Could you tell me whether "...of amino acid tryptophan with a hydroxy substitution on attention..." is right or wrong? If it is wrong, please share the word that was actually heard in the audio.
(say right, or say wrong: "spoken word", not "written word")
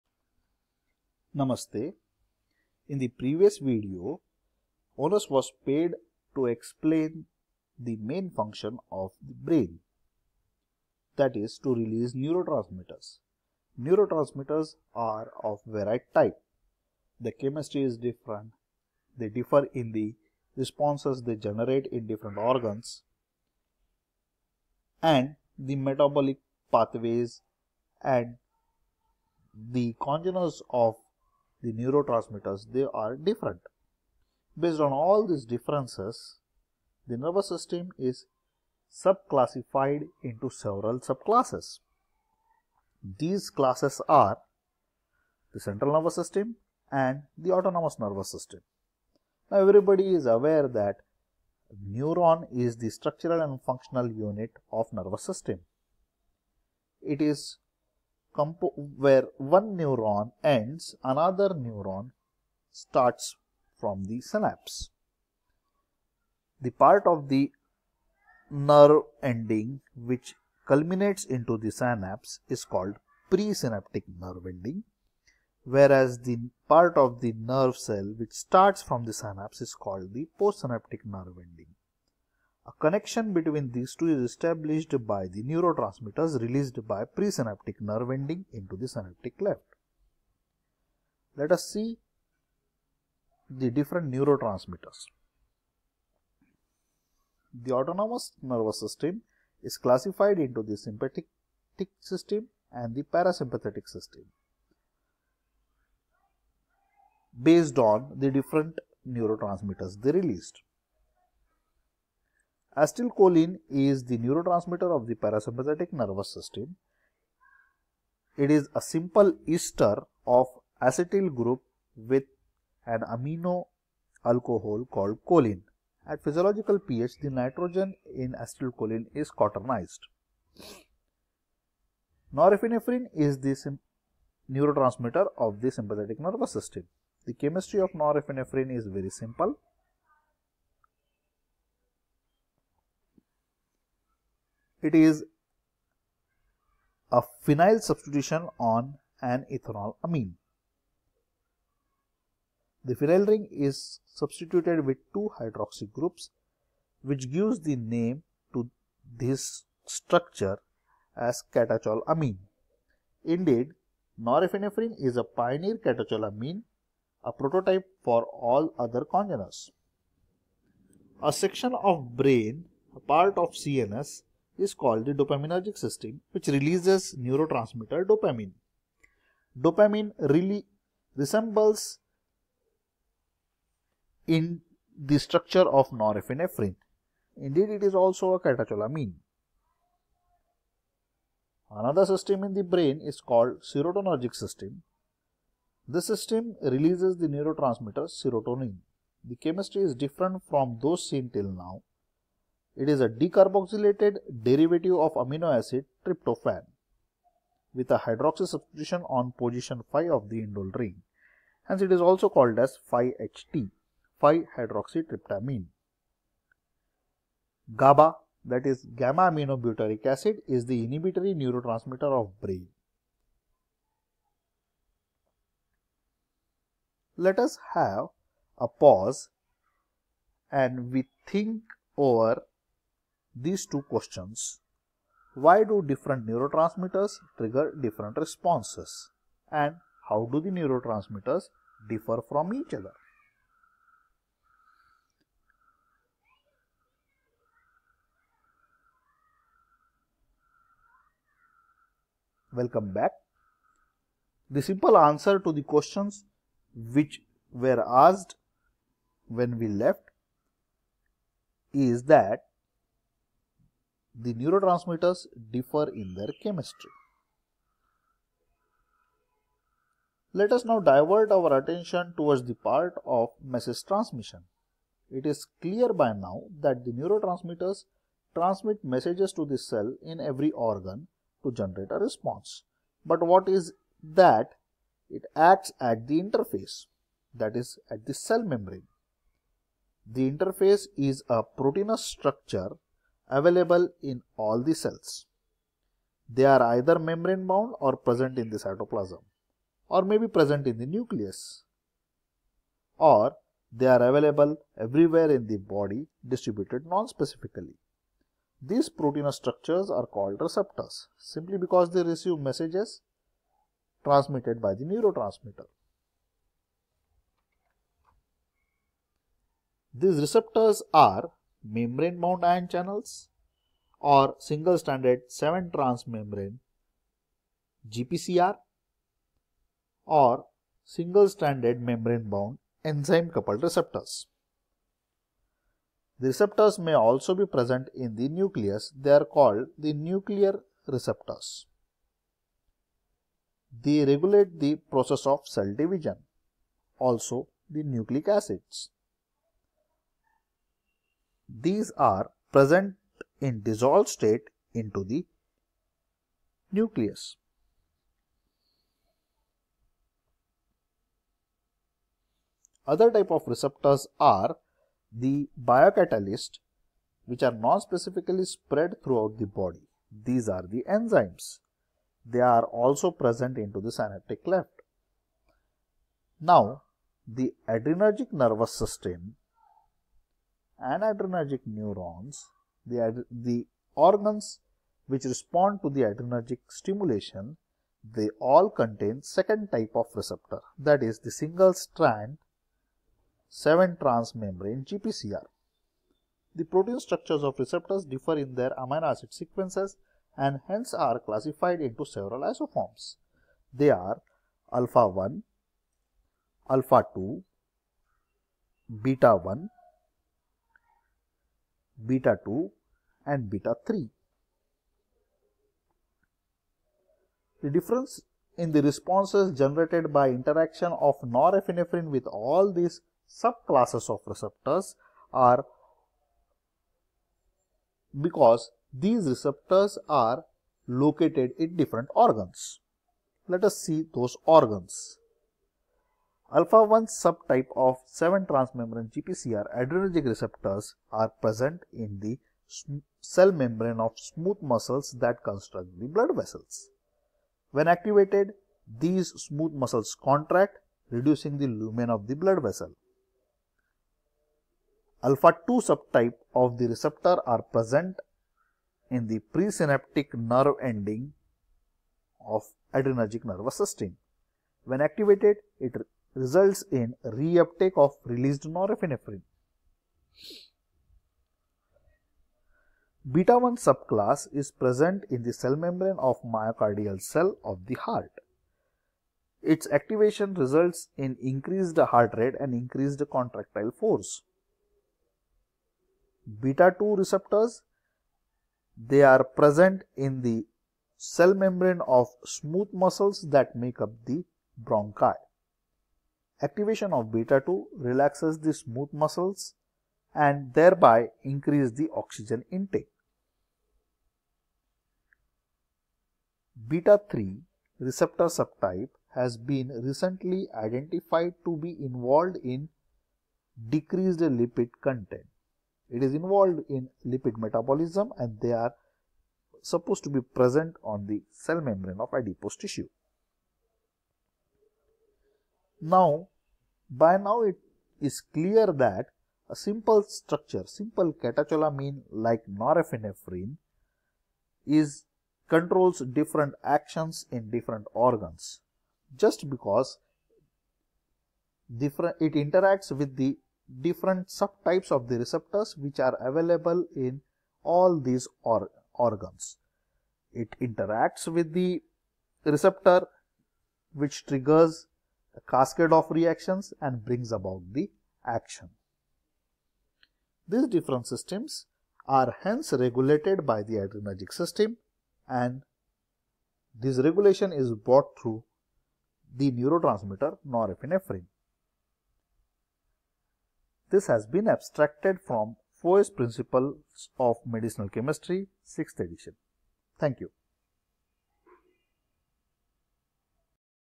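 wrong: "position", not "attention".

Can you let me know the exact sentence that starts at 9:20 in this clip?
These different systems are hence regulated by the adrenergic system and this regulation is brought through the neurotransmitter norepinephrine.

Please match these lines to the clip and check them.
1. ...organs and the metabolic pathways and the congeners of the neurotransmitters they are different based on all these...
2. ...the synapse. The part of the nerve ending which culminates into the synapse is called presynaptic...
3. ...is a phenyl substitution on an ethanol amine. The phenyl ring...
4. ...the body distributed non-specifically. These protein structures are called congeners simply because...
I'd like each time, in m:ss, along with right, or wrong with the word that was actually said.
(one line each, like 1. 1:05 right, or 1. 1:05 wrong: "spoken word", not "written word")
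1. 0:22 right
2. 1:04 right
3. 2:24 right
4. 5:05 wrong: "receptors", not "congeners".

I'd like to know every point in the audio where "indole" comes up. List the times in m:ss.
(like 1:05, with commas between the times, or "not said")
3:30.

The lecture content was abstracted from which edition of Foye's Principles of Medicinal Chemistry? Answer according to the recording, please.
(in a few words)
6th edition.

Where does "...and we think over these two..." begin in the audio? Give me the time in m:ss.
3:50.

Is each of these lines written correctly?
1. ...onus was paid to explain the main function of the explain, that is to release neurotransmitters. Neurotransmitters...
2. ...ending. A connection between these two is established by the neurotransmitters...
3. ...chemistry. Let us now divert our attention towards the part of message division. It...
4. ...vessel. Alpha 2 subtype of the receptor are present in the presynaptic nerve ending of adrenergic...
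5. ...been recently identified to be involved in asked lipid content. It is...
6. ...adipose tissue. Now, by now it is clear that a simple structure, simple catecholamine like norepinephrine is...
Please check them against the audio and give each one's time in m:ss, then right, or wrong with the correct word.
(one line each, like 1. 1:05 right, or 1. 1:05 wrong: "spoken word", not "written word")
1. 0:04 wrong: "brain", not "explain"
2. 1:21 right
3. 4:26 wrong: "transmission", not "division"
4. 7:32 right
5. 8:29 wrong: "decreased", not "asked"
6. 8:42 right.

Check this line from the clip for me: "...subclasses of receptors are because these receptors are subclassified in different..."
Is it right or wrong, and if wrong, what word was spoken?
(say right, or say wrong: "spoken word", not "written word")
wrong: "located", not "subclassified".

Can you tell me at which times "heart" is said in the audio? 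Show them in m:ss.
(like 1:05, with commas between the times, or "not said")
7:57, 8:01.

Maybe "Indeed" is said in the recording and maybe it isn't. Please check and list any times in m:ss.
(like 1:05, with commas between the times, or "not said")
2:43, 3:07.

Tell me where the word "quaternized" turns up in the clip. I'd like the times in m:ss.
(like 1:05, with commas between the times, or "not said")
2:09.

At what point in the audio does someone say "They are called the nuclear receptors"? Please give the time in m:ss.
5:38.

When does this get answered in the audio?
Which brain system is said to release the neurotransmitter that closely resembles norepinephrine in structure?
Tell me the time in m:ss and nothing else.
2:55.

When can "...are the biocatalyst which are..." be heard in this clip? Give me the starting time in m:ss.
6:04.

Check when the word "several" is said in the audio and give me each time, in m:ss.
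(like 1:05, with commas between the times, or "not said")
0:40, 6:42.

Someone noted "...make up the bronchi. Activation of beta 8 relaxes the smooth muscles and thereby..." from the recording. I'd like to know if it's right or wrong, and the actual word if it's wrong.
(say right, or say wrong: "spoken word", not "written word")
wrong: "2", not "8".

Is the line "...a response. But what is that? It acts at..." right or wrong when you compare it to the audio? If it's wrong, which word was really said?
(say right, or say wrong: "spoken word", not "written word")
right.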